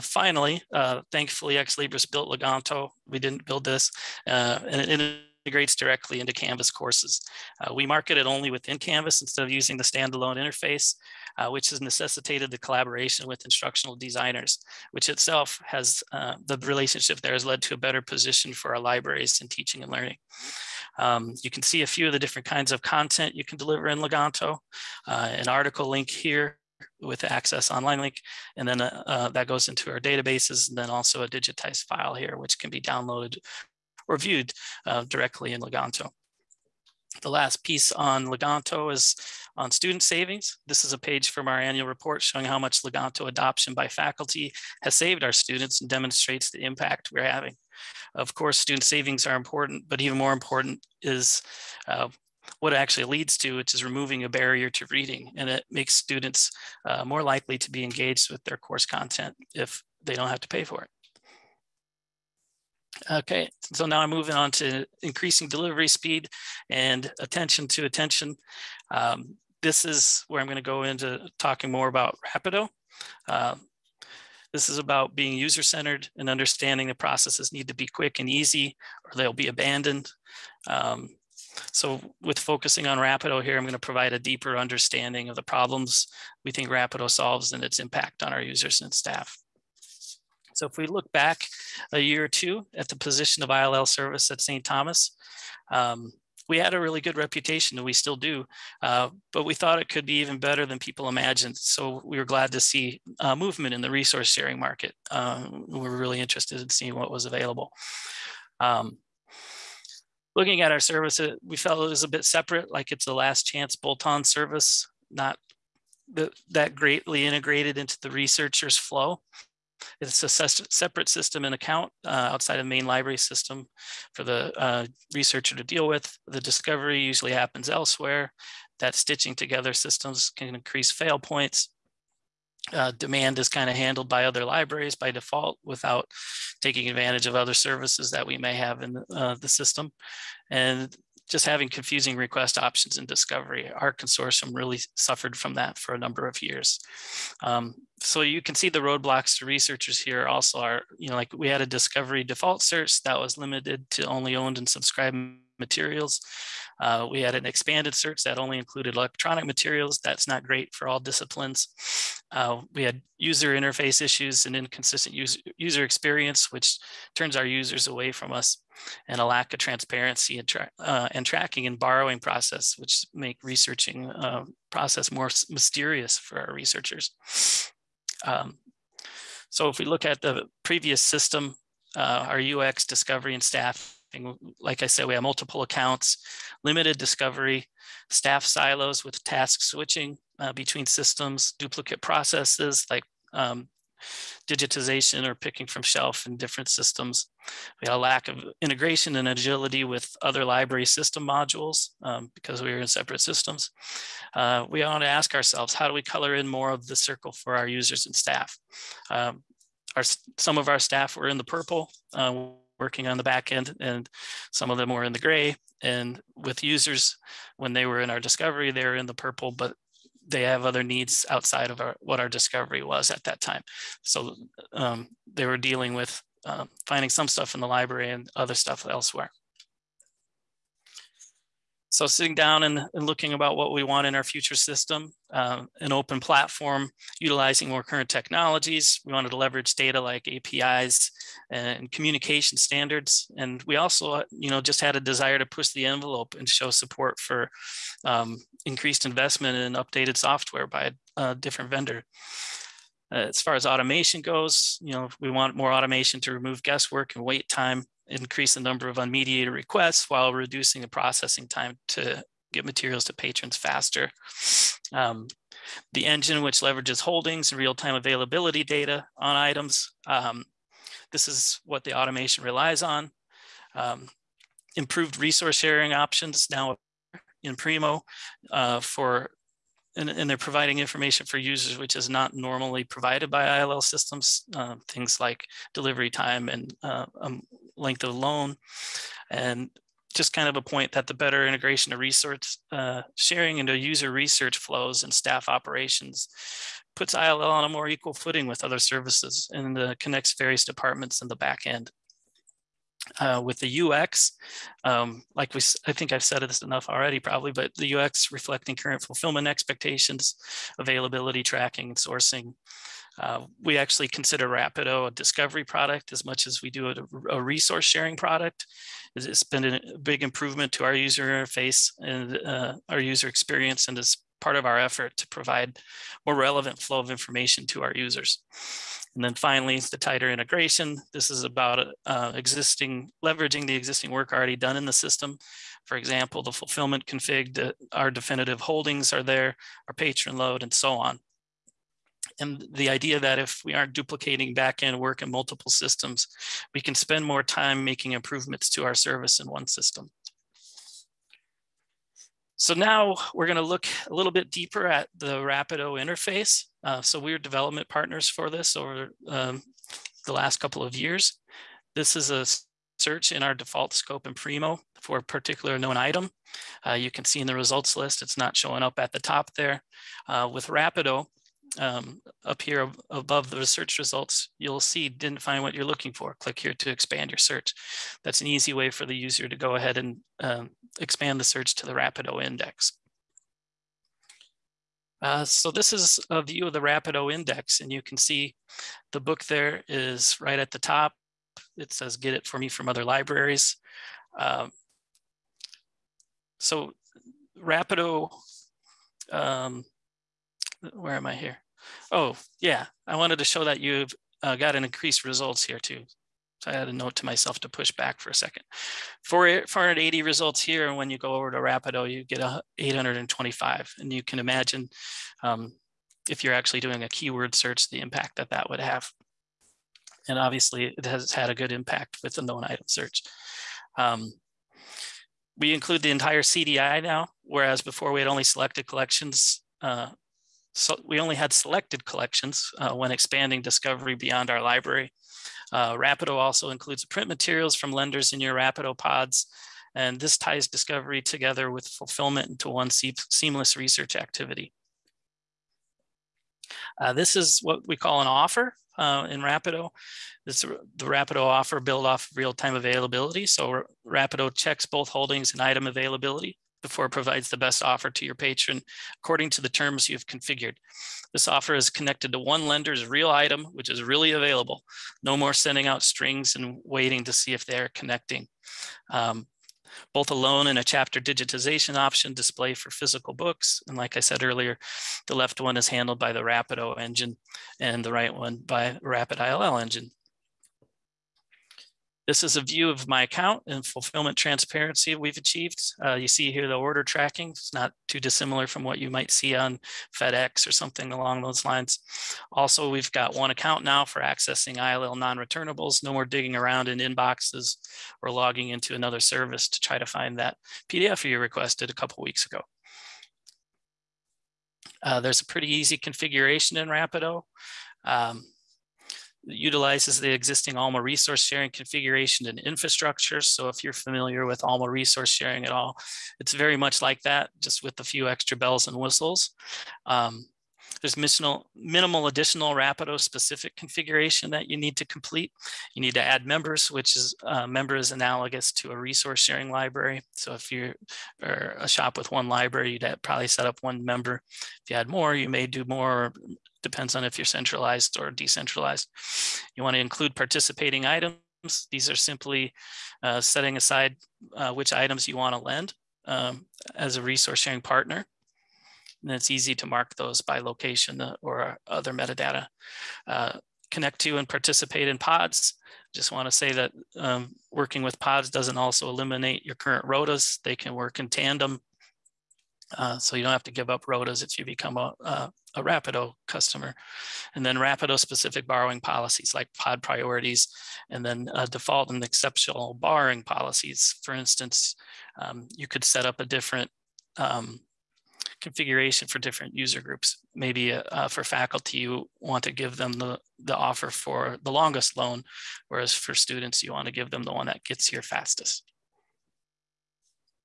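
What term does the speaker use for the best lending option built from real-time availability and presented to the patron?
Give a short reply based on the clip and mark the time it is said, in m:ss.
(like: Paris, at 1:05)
an offer, at 7:28.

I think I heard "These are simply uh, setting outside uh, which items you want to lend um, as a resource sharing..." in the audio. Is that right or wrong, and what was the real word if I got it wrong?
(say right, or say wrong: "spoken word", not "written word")
wrong: "aside", not "outside".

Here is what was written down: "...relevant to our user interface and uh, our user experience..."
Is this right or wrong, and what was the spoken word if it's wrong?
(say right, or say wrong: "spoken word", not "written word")
wrong: "improvement", not "relevant".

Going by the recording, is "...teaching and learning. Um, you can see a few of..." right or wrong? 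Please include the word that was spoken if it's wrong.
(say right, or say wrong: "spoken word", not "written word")
right.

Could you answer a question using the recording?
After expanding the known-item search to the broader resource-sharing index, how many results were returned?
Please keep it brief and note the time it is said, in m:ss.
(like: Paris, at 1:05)
825, at 6:52.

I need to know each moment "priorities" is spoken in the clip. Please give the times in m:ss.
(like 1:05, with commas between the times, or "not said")
9:30.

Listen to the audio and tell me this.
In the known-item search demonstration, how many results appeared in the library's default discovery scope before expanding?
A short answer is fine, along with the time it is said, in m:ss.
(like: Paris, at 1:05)
480, at 6:49.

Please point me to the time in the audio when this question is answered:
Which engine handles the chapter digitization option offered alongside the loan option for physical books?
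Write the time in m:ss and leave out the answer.
7:59.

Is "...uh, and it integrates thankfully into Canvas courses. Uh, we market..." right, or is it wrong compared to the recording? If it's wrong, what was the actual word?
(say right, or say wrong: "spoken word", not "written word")
wrong: "directly", not "thankfully".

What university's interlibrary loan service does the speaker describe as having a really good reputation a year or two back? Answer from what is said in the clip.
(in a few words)
St. Thomas.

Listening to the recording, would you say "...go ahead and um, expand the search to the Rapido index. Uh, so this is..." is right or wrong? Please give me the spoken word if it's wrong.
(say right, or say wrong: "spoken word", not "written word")
right.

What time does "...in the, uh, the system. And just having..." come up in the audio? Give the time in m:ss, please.
2:18.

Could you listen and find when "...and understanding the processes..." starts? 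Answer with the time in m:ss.
1:16.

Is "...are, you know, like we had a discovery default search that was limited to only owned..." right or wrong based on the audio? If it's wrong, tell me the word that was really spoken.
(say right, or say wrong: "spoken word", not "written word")
right.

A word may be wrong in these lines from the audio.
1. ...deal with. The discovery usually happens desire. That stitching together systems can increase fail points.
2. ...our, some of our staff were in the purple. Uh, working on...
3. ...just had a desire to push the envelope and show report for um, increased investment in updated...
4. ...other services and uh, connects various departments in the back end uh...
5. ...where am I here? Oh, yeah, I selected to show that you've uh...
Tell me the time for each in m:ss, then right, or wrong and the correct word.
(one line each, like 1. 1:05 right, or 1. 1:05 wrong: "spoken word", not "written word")
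1. 2:05 wrong: "elsewhere", not "desire"
2. 3:29 right
3. 4:04 wrong: "support", not "report"
4. 4:58 right
5. 6:40 wrong: "wanted", not "selected".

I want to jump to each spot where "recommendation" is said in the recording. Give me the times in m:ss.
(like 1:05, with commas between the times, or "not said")
not said.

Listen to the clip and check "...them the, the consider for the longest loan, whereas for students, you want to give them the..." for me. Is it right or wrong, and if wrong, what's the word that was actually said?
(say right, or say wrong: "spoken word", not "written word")
wrong: "offer", not "consider".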